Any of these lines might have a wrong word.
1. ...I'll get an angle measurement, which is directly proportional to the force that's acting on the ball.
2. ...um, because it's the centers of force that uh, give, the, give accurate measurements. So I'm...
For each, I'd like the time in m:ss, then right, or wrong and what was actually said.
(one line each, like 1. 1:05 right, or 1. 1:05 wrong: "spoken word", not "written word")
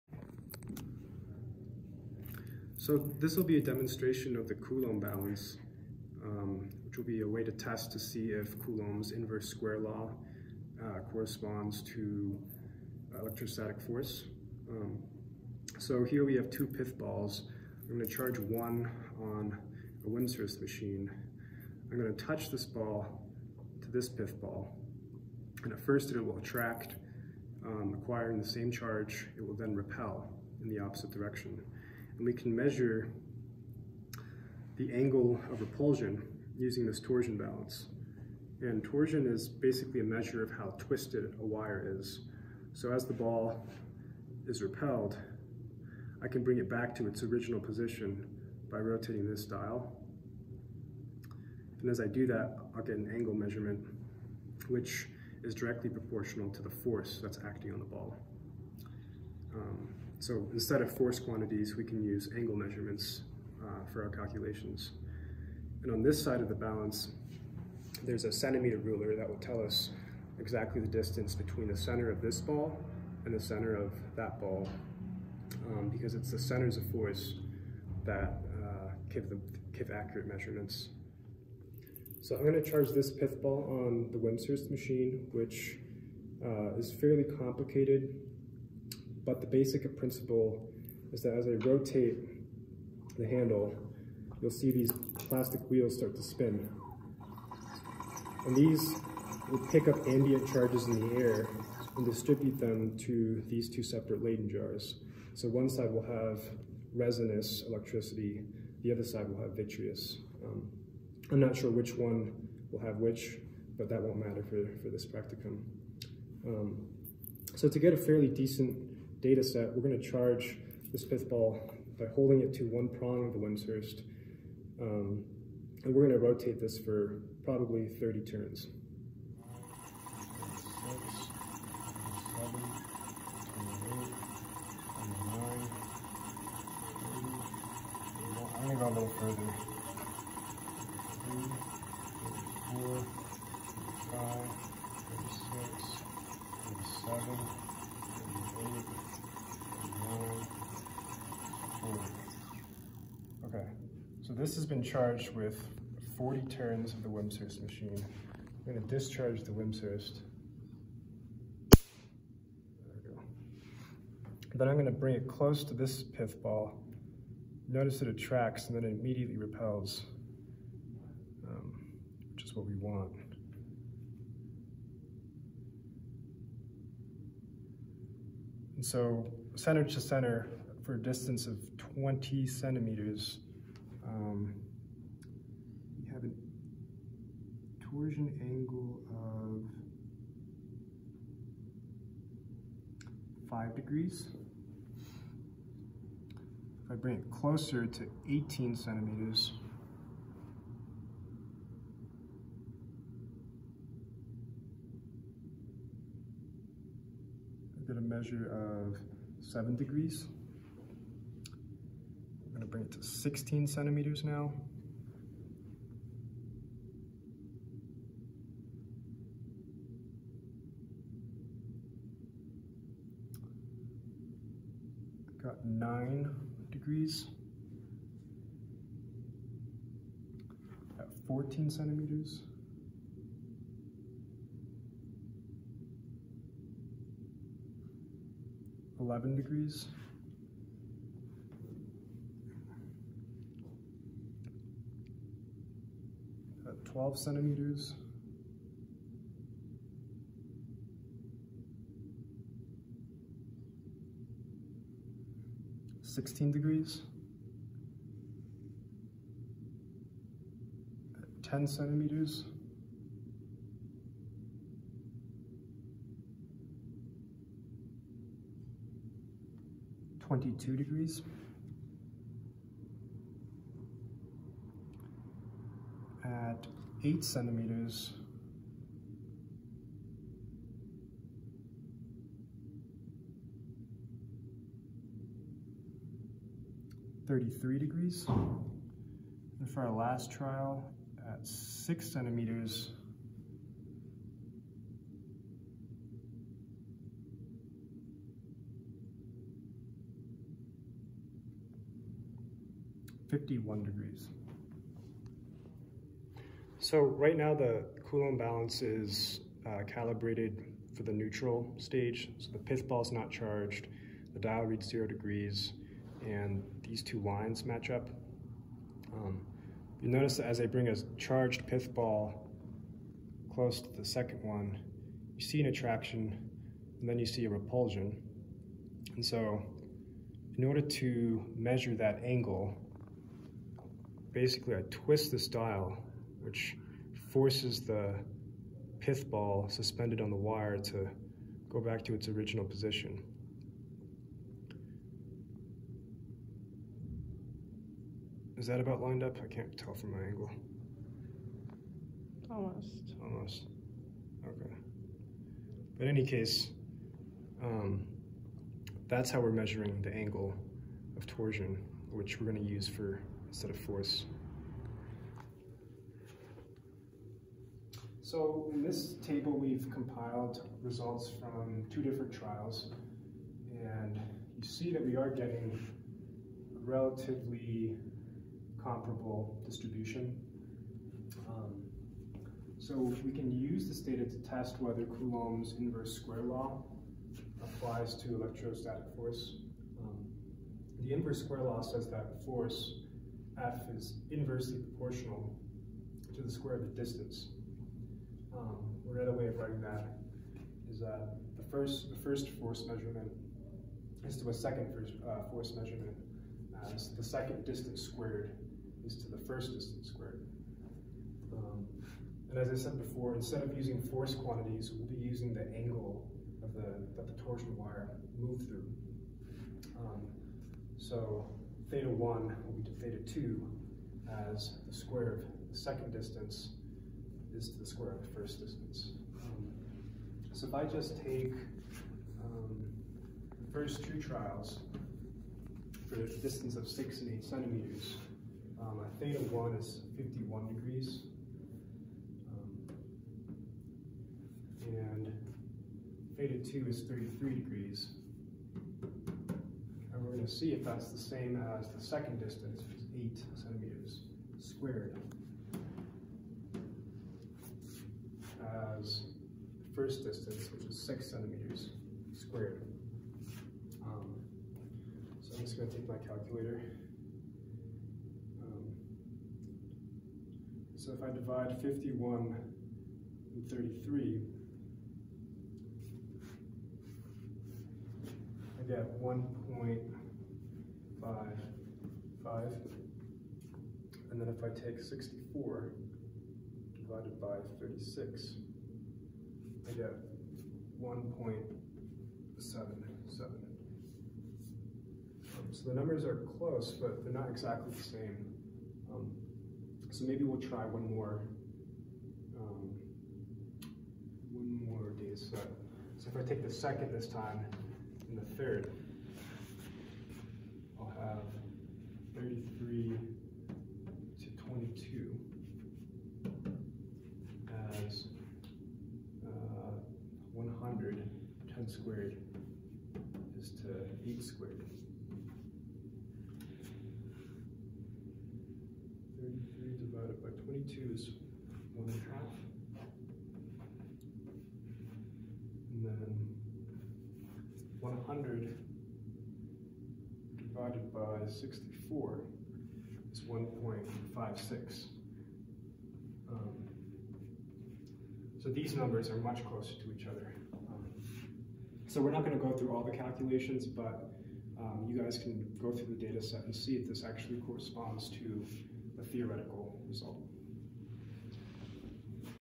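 1. 0:52 right
2. 1:15 right.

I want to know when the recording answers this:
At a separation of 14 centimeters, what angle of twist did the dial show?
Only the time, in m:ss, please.
3:58.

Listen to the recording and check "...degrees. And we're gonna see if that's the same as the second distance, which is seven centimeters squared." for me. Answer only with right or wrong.
wrong.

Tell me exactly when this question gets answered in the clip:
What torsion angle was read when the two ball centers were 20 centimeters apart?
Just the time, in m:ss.
3:13.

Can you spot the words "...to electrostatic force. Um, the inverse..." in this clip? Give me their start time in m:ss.
6:28.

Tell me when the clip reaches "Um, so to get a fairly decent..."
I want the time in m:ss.
1:56.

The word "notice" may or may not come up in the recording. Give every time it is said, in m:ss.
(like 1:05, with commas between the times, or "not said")
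2:47, 5:20.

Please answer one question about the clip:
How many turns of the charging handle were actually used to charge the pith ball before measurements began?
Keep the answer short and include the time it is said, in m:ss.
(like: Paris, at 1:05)
40, at 2:36.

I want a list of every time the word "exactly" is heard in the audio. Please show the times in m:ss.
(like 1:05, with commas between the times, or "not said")
1:10, 8:17.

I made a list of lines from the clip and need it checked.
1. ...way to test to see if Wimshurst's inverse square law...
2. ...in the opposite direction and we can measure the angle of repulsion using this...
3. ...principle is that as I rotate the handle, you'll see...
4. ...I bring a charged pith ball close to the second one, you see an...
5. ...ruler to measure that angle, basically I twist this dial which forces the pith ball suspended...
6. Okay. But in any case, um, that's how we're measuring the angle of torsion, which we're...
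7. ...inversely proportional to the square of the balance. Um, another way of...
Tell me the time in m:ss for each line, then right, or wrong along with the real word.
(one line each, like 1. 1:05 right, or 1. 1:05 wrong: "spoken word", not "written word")
1. 0:07 wrong: "Coulomb", not "Wimshurst"
2. 0:30 right
3. 1:29 right
4. 5:20 right
5. 5:30 wrong: "order", not "ruler"
6. 5:54 right
7. 6:34 wrong: "distance", not "balance".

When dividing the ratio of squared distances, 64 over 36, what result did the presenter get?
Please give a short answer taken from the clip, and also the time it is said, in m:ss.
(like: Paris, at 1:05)
1.77, at 8:11.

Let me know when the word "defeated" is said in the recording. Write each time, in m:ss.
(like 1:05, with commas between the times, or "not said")
not said.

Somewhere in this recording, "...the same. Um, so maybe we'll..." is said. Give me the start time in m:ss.
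8:17.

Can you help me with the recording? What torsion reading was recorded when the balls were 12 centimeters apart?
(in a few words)
16 degrees.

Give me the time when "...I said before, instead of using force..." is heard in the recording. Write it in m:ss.
6:52.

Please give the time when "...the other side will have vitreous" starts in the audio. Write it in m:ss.
1:48.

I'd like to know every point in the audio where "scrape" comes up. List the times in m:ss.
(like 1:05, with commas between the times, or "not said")
not said.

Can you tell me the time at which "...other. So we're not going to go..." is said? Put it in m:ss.
9:10.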